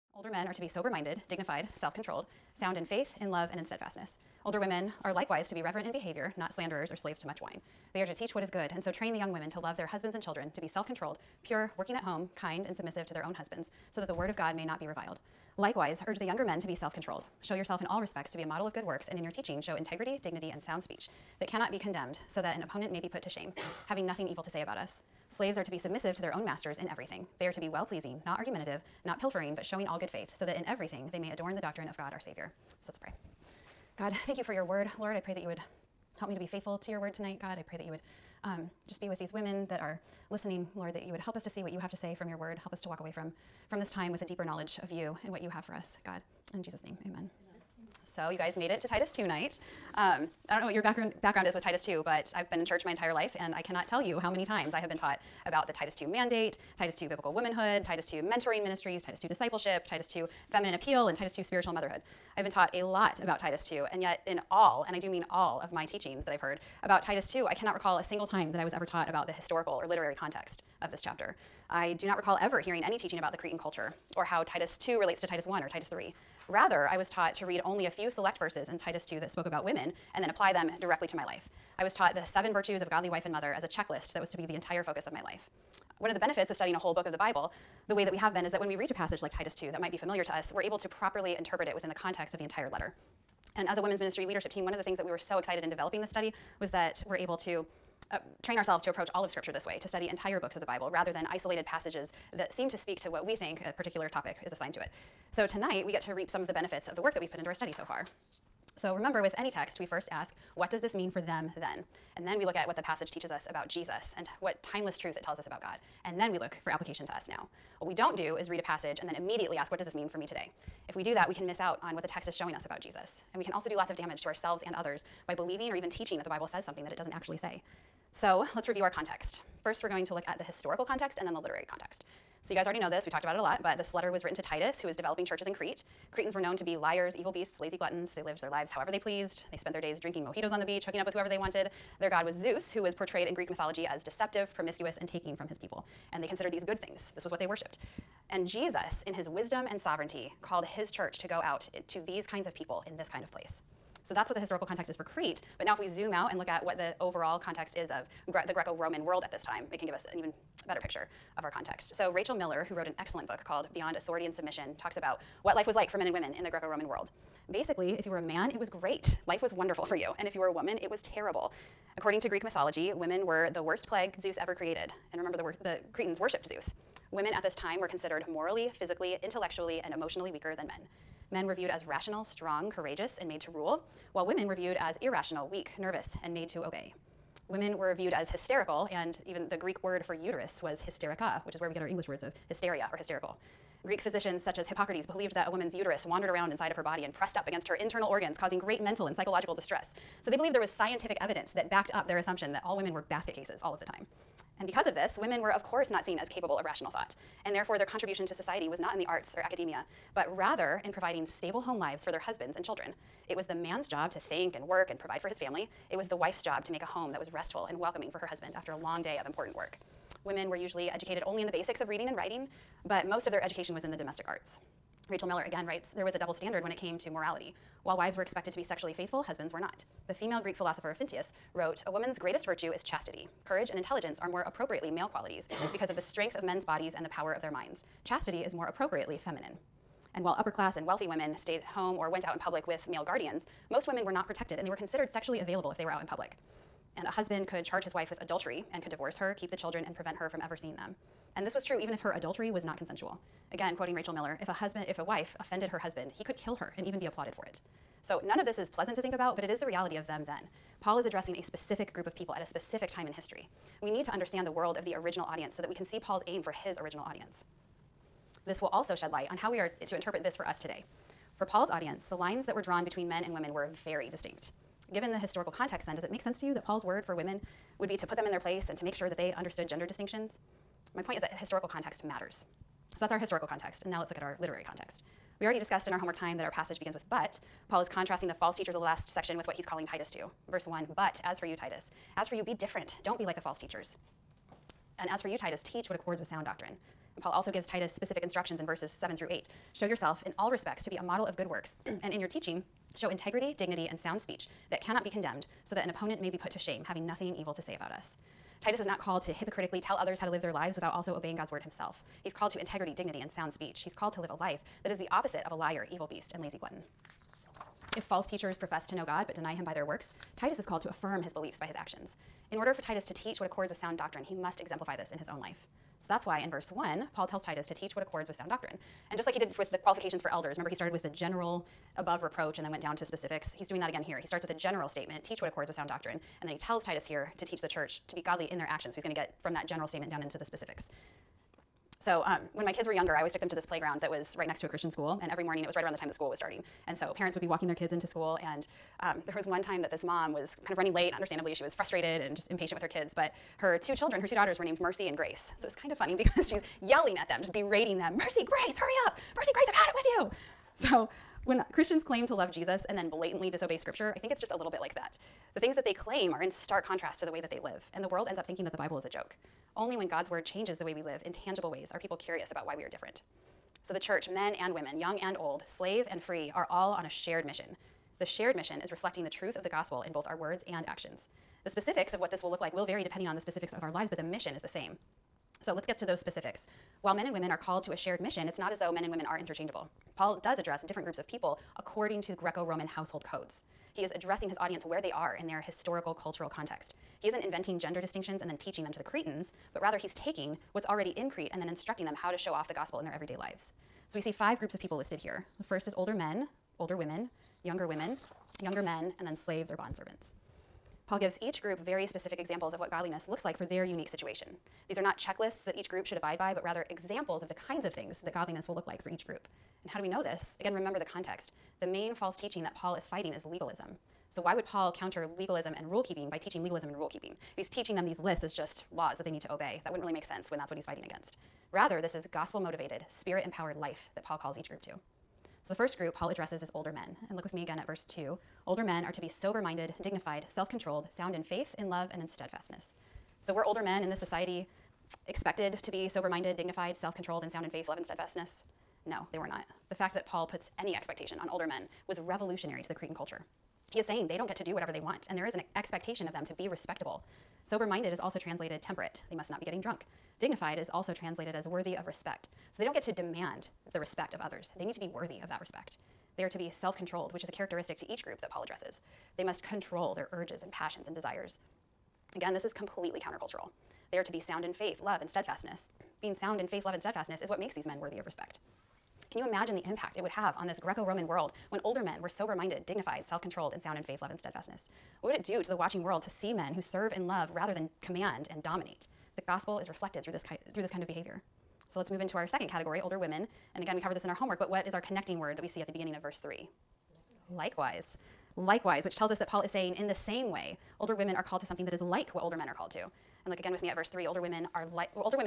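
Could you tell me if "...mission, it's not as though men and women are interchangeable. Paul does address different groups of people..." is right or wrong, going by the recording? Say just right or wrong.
right.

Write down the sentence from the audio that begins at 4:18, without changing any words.
So none of this is pleasant to think about, but it is the reality of them then.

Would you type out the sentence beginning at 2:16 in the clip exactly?
Cretans were known to be liars, evil beasts, lazy gluttons.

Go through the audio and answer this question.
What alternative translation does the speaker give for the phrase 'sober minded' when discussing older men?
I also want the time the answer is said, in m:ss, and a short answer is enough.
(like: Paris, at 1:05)
Temperate, at 7:38.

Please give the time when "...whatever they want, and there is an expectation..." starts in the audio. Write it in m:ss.
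7:34.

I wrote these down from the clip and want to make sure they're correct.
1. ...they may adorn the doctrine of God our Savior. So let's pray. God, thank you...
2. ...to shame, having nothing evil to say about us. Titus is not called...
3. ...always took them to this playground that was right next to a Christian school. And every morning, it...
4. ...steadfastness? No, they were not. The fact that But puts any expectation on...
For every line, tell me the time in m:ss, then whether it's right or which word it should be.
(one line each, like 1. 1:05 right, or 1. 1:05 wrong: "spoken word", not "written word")
1. 0:31 right
2. 5:06 right
3. 5:43 right
4. 7:28 wrong: "Paul", not "But".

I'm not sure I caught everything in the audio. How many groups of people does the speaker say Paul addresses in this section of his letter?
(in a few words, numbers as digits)
5.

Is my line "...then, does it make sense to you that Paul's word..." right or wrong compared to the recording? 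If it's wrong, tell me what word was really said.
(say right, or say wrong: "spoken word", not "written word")
right.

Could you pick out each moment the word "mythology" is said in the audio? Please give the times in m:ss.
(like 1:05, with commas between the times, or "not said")
2:23, 2:52.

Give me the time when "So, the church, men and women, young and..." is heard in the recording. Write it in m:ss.
6:13.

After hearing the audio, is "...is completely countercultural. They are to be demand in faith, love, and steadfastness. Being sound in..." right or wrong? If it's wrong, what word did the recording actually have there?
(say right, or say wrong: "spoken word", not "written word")
wrong: "sound", not "demand".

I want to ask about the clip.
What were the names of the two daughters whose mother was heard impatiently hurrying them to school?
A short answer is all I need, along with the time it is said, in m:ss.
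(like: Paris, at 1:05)
Mercy and Grace, at 5:54.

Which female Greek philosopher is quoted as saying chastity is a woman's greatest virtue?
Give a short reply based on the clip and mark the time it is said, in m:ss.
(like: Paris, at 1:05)
Phintys, at 3:50.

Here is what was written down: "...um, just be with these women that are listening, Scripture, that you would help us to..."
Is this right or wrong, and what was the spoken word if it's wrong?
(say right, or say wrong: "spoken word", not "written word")
wrong: "Lord", not "Scripture".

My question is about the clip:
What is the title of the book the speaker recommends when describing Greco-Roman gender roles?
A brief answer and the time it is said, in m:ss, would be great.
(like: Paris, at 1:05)
Beyond Authority and Submission, at 2:43.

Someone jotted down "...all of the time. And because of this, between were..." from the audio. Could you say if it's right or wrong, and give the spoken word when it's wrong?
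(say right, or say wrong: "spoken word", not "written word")
wrong: "women", not "between".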